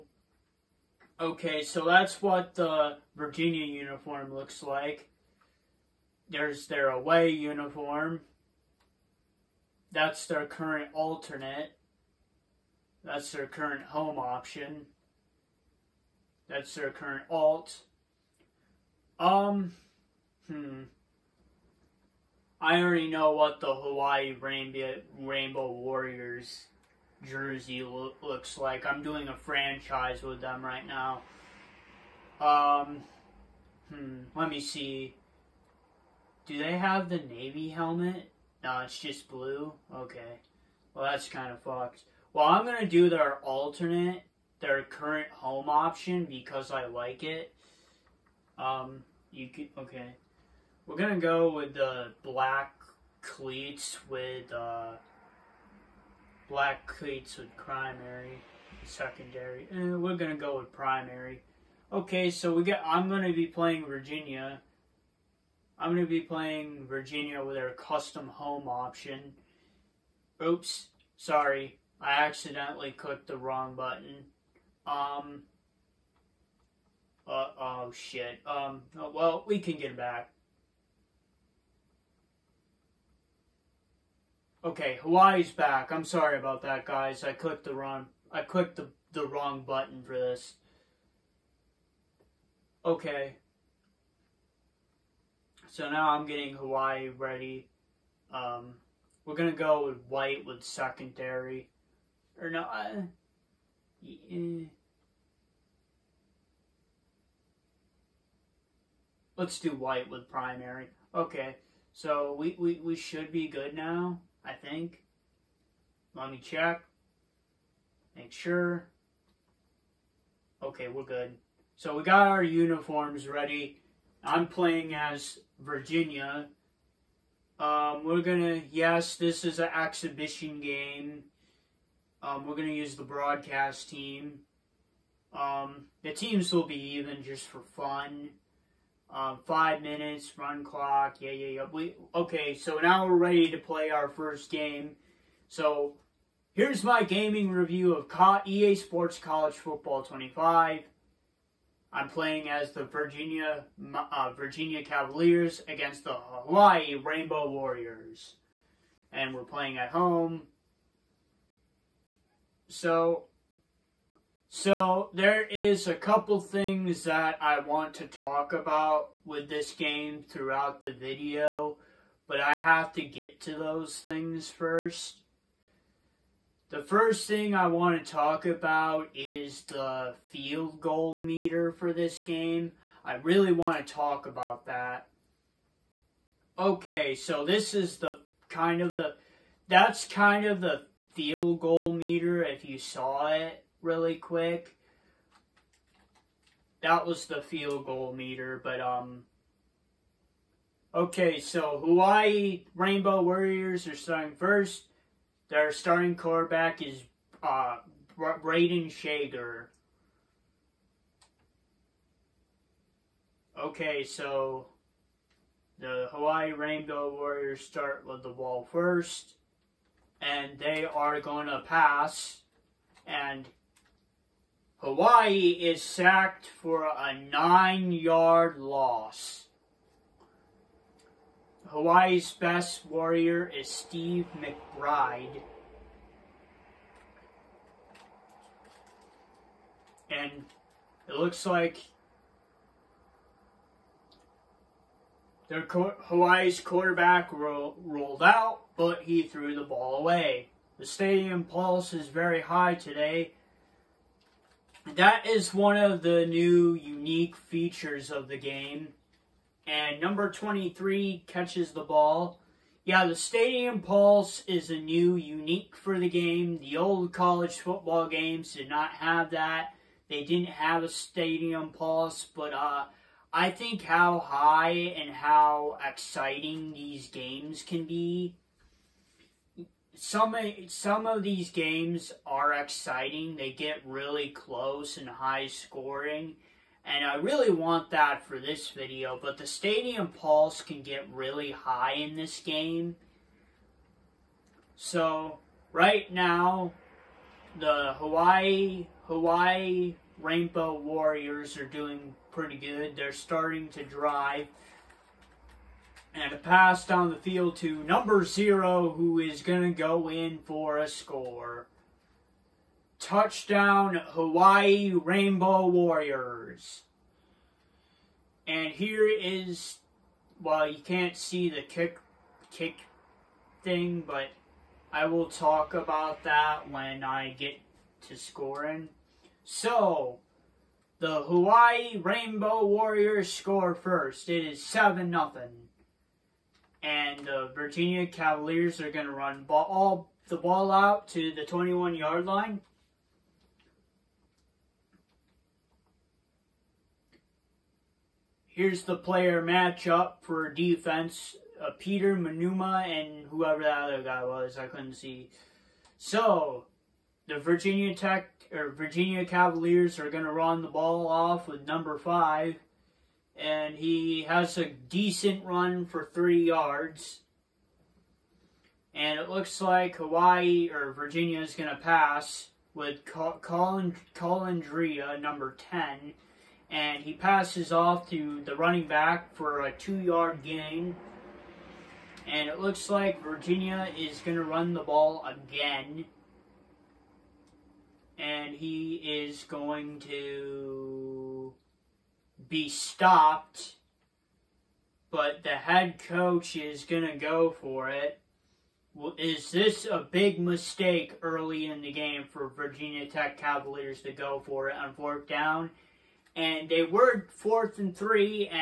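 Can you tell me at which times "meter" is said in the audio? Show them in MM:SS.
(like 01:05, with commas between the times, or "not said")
03:01, 03:11, 03:18.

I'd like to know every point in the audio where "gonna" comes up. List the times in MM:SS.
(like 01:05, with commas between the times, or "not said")
02:08, 02:12.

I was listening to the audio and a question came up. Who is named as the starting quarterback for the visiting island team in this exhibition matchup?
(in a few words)
Brayden Schager.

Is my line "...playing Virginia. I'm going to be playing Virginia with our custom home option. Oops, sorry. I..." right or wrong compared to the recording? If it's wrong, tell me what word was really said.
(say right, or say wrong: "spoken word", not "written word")
right.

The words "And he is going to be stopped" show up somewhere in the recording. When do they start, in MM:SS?
06:28.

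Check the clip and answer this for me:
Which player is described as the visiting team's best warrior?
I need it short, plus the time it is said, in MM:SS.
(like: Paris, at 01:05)
Steve McBride, at 03:53.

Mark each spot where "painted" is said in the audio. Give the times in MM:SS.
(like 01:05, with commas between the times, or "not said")
not said.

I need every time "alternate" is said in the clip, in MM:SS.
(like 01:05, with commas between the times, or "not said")
00:10, 00:43.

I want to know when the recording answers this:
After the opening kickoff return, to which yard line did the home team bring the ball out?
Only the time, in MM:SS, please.
05:41.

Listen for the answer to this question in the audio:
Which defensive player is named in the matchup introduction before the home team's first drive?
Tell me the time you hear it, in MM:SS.
05:51.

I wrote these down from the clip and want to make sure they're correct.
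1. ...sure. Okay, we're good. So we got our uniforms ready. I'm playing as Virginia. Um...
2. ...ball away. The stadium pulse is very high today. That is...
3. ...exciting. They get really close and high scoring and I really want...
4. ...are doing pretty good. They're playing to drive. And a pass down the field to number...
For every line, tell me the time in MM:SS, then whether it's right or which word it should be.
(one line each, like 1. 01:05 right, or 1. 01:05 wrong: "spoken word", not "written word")
1. 01:58 right
2. 04:09 right
3. 04:42 right
4. 05:01 wrong: "starting", not "playing".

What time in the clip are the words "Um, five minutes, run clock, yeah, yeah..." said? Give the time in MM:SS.
02:19.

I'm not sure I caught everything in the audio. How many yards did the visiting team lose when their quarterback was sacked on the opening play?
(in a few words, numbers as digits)
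9.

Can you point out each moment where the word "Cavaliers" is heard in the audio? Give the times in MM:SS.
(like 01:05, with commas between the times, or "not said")
02:34, 05:38, 05:59, 06:43.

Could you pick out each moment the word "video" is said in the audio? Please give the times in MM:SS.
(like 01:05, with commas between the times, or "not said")
02:50, 04:48.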